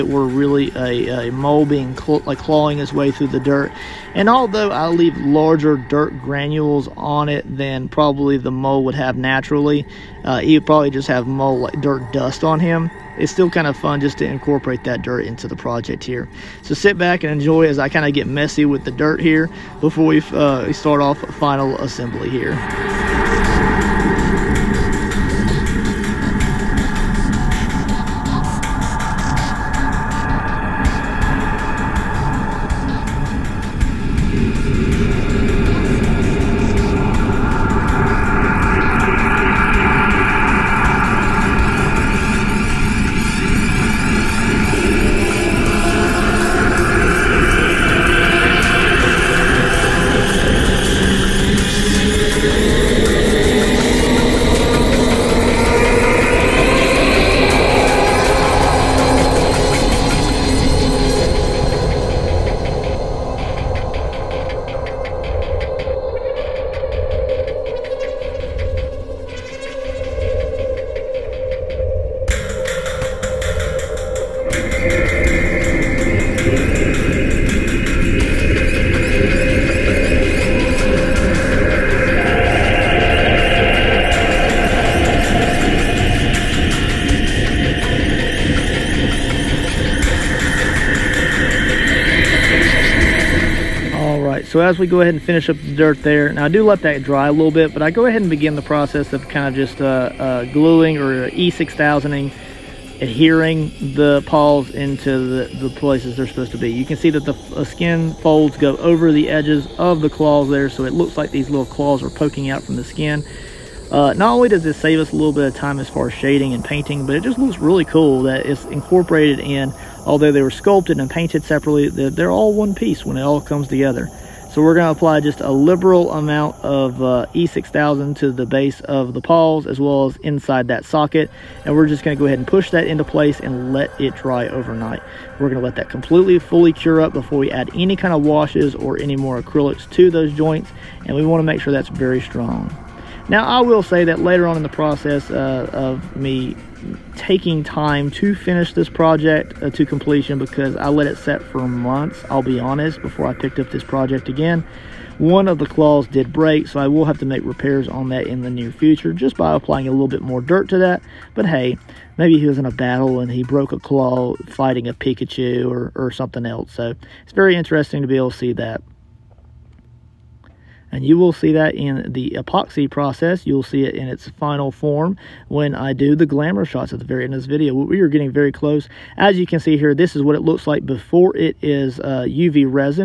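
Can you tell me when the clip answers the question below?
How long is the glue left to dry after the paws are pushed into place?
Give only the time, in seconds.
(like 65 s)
134 s.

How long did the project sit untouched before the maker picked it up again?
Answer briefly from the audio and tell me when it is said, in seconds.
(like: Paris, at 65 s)
Months, at 151 s.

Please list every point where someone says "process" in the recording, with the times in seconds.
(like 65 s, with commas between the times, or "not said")
98 s, 144 s, 172 s.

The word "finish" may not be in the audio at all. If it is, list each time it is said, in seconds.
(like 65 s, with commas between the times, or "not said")
95 s, 148 s.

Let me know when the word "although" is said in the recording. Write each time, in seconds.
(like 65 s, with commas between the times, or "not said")
4 s, 120 s.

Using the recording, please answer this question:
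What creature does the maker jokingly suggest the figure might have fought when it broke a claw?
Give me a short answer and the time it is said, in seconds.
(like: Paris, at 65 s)
A Pikachu, at 164 s.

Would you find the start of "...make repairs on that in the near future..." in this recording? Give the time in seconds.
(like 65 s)
157 s.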